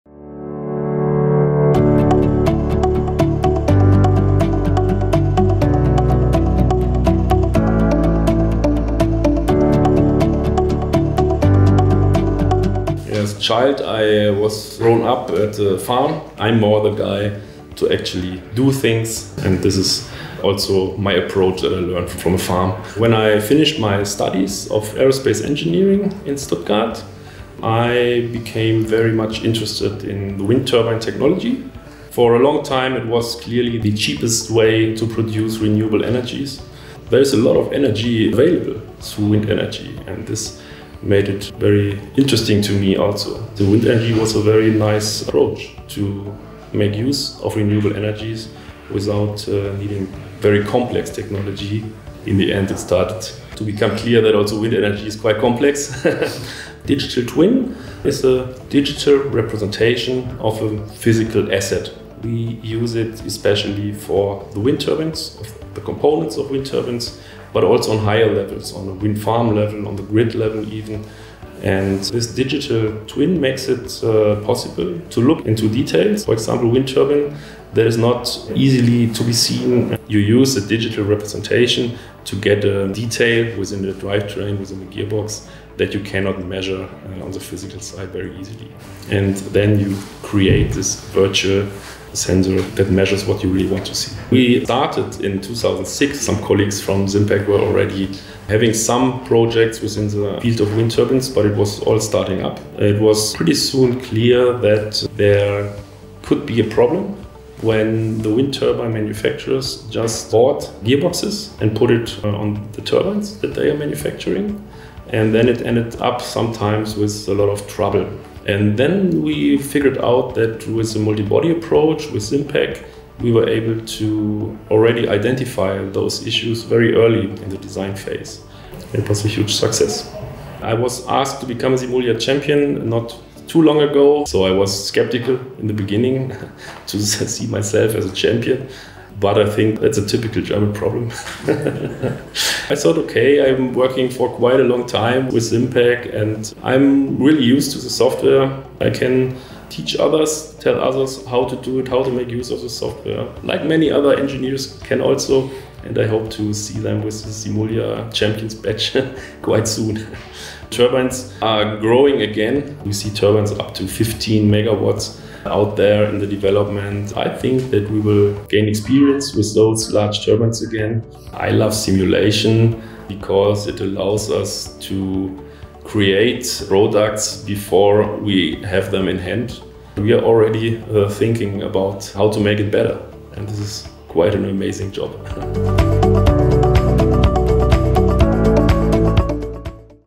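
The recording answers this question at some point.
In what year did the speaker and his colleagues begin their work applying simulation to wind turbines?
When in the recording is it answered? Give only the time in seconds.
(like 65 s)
95 s.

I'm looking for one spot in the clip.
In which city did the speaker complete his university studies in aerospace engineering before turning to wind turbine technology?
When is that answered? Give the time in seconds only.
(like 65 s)
26 s.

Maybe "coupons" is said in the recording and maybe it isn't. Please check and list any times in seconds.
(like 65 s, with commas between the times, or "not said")
not said.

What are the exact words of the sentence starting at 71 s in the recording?
And this digital twin makes it uh, possible to look into details.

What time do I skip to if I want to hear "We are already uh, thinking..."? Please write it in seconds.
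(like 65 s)
179 s.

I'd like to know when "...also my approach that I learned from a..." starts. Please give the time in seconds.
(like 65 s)
20 s.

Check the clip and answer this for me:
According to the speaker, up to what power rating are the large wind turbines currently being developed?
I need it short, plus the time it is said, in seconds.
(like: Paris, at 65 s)
15 megawatts, at 163 s.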